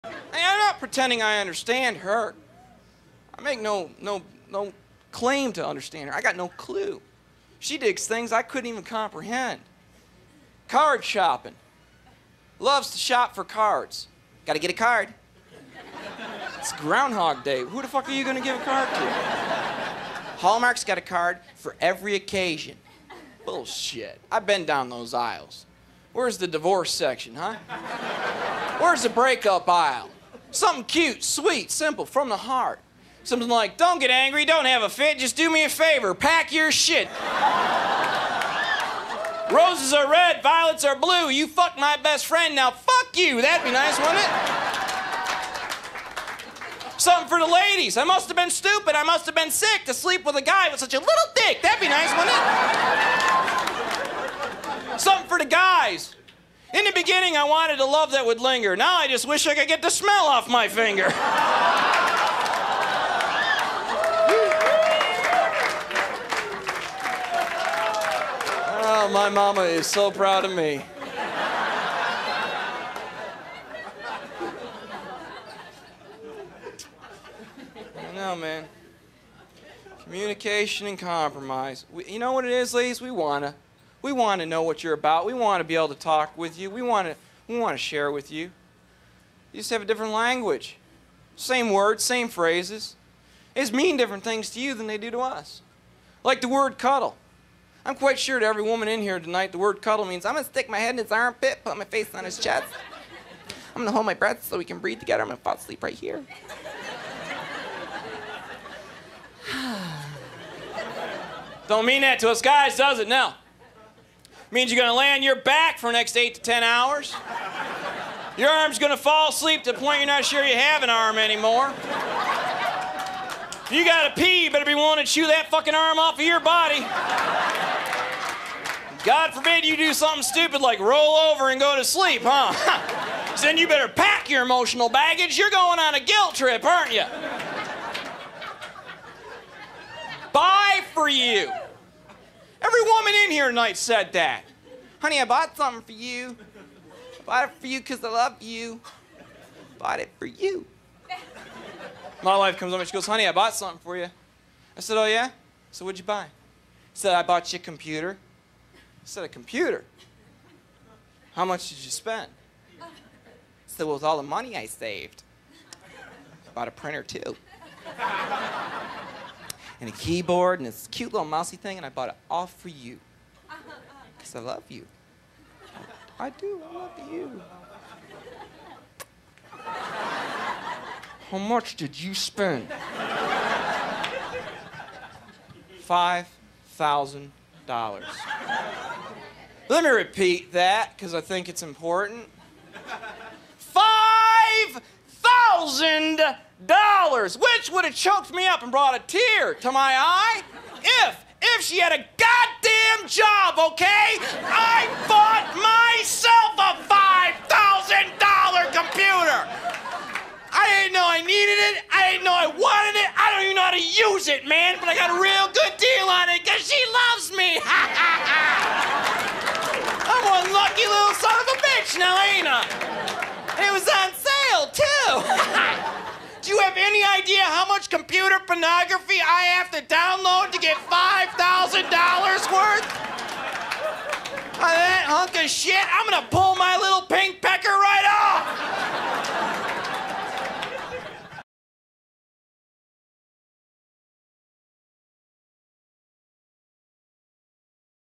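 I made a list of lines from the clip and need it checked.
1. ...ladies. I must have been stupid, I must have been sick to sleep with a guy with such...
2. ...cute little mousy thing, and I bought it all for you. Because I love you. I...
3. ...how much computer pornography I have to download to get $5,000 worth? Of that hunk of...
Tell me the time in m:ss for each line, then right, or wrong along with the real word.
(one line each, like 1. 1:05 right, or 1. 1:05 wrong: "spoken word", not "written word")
1. 0:47 right
2. 2:50 right
3. 3:47 right.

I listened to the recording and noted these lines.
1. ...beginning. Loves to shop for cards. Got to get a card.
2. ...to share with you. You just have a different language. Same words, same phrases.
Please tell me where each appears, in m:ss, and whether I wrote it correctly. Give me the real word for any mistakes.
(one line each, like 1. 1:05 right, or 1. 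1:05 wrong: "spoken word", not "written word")
1. 0:11 wrong: "shopping", not "beginning"
2. 1:27 right.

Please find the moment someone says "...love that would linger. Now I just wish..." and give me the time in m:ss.
0:57.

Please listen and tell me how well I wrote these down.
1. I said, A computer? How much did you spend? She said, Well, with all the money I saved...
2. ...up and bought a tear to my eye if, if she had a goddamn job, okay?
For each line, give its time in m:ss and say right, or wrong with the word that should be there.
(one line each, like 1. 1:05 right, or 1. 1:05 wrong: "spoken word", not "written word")
1. 2:38 right
2. 3:18 wrong: "brought", not "bought".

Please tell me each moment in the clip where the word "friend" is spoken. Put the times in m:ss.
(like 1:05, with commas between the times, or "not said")
0:42.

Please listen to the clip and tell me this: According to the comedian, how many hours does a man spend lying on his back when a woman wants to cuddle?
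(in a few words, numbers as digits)
8 to 10 hours.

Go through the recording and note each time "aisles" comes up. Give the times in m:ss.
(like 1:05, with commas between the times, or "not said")
0:25, 0:29.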